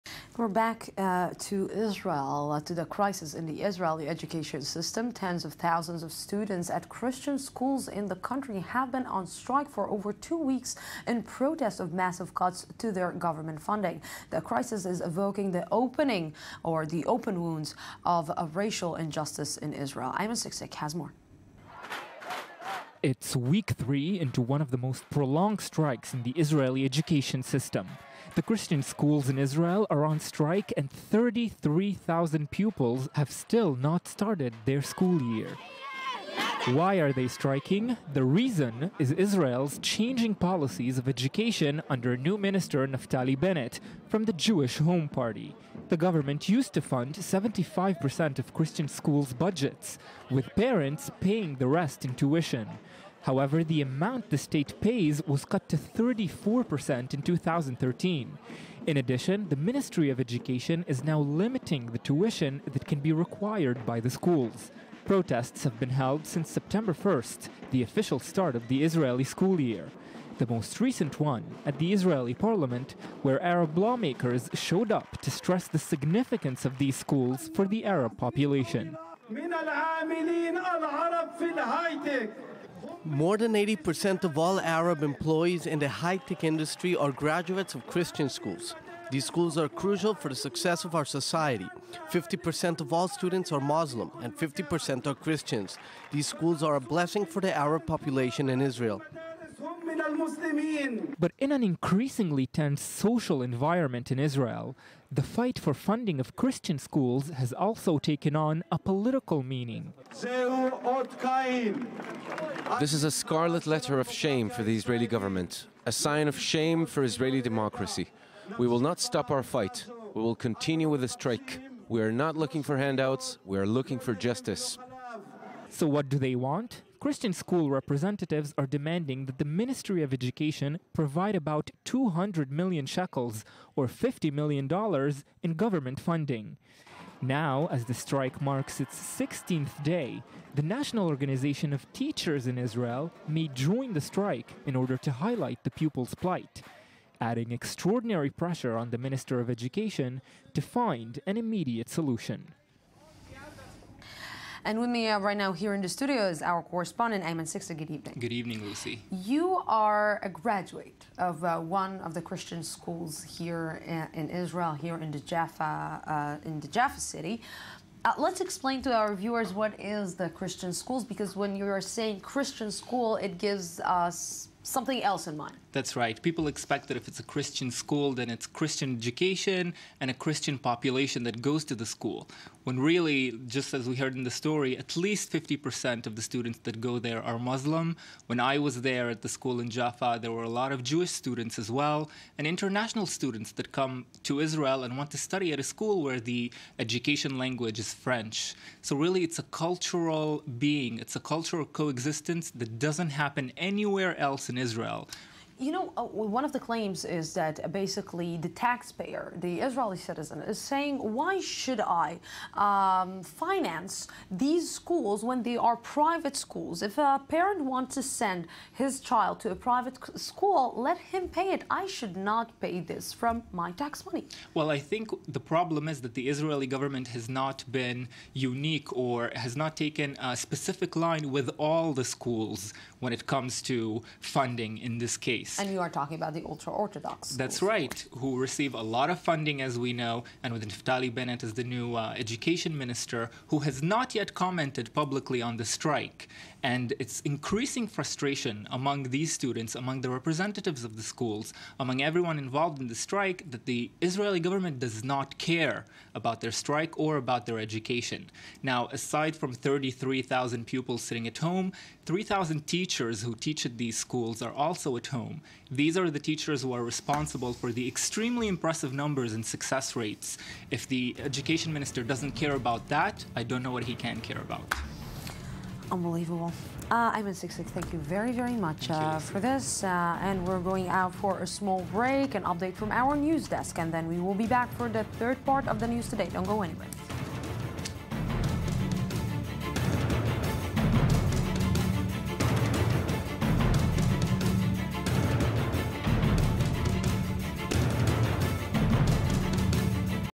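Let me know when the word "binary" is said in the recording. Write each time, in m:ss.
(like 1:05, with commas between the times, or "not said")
not said.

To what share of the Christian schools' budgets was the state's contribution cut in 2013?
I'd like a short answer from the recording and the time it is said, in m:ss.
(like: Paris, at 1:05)
34%, at 0:55.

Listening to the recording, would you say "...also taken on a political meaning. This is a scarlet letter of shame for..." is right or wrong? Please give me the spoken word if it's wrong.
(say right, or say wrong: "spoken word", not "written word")
right.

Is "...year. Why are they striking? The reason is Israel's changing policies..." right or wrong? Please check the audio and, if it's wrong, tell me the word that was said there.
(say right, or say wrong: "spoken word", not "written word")
right.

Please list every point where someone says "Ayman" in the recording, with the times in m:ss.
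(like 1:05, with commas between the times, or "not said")
0:20, 2:37.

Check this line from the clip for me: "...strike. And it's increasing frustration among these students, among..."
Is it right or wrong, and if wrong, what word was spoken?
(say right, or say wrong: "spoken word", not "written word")
right.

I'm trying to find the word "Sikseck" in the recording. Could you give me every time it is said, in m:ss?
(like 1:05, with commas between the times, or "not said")
0:20, 2:37.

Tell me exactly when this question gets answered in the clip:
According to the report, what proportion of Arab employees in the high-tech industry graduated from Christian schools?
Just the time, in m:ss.
1:23.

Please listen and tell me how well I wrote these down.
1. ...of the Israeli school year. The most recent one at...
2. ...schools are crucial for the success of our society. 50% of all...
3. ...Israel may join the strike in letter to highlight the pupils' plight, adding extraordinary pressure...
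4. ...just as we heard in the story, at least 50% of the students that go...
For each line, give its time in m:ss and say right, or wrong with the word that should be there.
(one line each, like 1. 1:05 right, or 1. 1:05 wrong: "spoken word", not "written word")
1. 1:08 right
2. 1:29 right
3. 2:22 wrong: "order", not "letter"
4. 3:03 right.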